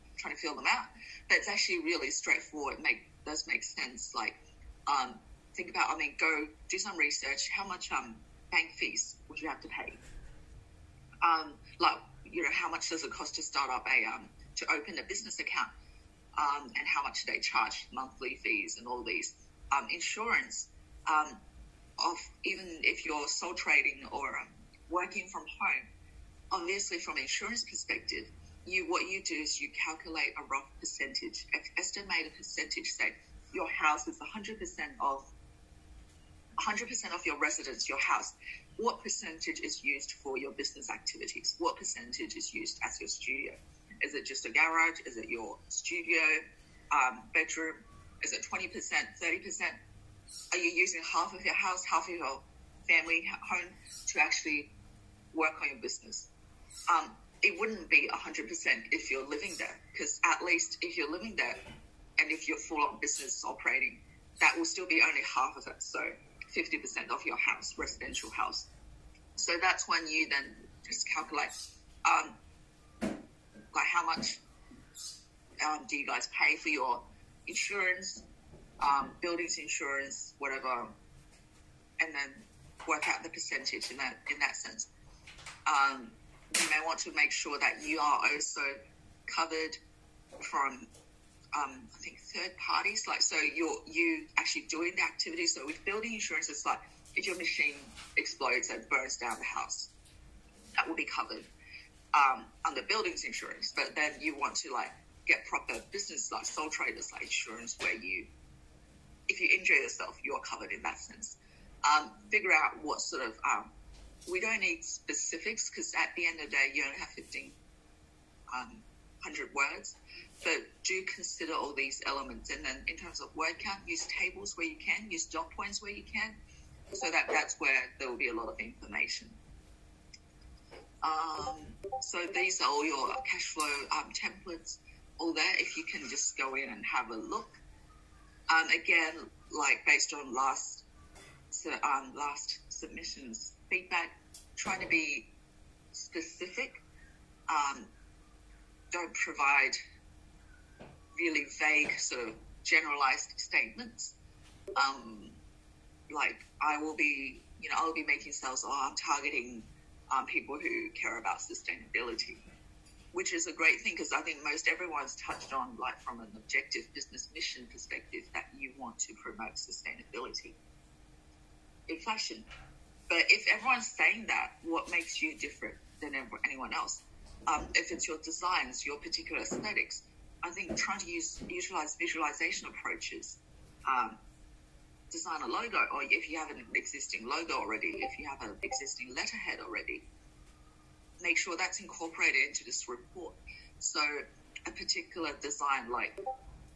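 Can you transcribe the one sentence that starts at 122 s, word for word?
And then in terms of word count, use tables where you can, use dot points where you can.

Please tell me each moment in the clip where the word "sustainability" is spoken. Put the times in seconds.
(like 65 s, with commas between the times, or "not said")
161 s, 169 s.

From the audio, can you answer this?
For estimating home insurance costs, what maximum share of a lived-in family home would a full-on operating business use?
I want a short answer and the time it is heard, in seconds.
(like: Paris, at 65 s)
50%, at 66 s.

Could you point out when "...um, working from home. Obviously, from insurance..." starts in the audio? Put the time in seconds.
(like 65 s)
24 s.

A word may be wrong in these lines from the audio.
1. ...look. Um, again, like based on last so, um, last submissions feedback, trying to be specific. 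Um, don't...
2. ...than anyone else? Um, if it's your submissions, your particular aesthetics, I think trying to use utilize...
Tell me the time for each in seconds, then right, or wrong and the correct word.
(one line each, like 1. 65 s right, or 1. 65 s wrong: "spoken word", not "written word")
1. 137 s right
2. 176 s wrong: "designs", not "submissions".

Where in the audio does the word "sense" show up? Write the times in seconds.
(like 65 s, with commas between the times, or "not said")
3 s, 84 s, 110 s.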